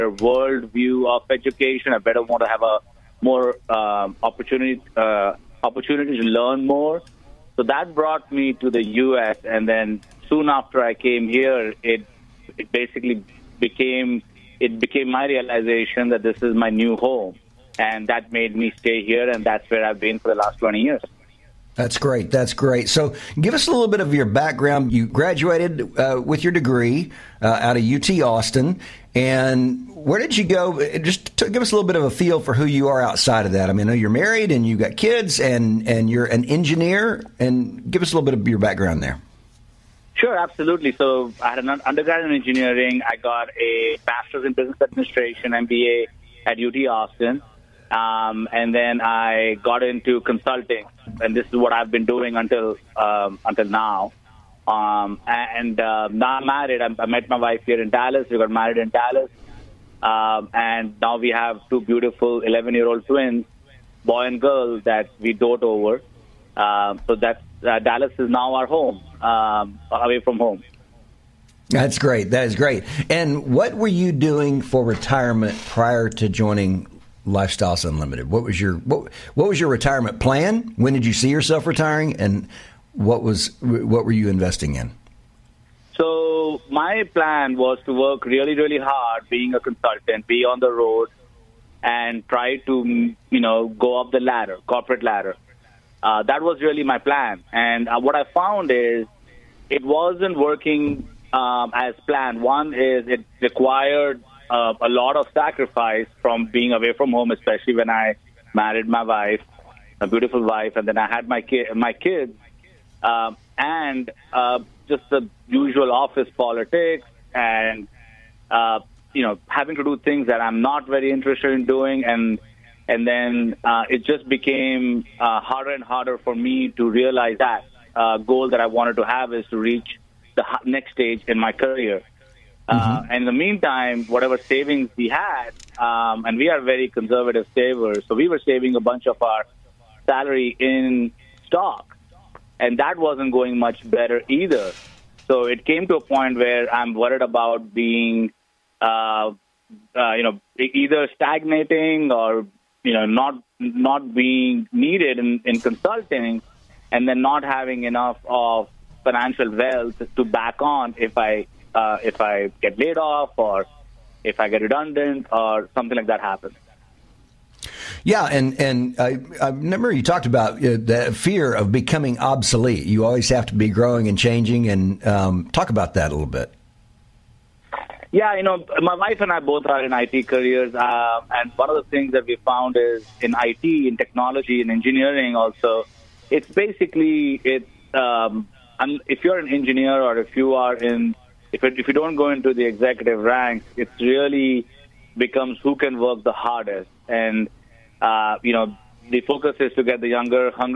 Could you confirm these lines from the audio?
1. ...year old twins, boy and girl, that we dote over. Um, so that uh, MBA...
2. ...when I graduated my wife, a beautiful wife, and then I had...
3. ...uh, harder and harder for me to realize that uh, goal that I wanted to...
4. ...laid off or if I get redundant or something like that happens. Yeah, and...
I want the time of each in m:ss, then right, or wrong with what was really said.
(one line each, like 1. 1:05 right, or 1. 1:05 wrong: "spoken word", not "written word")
1. 1:02 wrong: "Dallas", not "MBA"
2. 1:47 wrong: "married", not "graduated"
3. 2:05 right
4. 2:42 right.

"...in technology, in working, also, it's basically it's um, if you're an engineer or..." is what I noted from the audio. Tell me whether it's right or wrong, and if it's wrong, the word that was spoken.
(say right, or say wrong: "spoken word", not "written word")
wrong: "engineering", not "working".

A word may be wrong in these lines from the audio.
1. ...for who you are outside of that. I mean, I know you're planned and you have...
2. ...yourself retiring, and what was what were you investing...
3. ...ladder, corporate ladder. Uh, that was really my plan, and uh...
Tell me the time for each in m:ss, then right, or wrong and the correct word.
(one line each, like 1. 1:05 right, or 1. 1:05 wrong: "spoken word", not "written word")
1. 0:32 wrong: "married", not "planned"
2. 1:21 right
3. 1:34 right.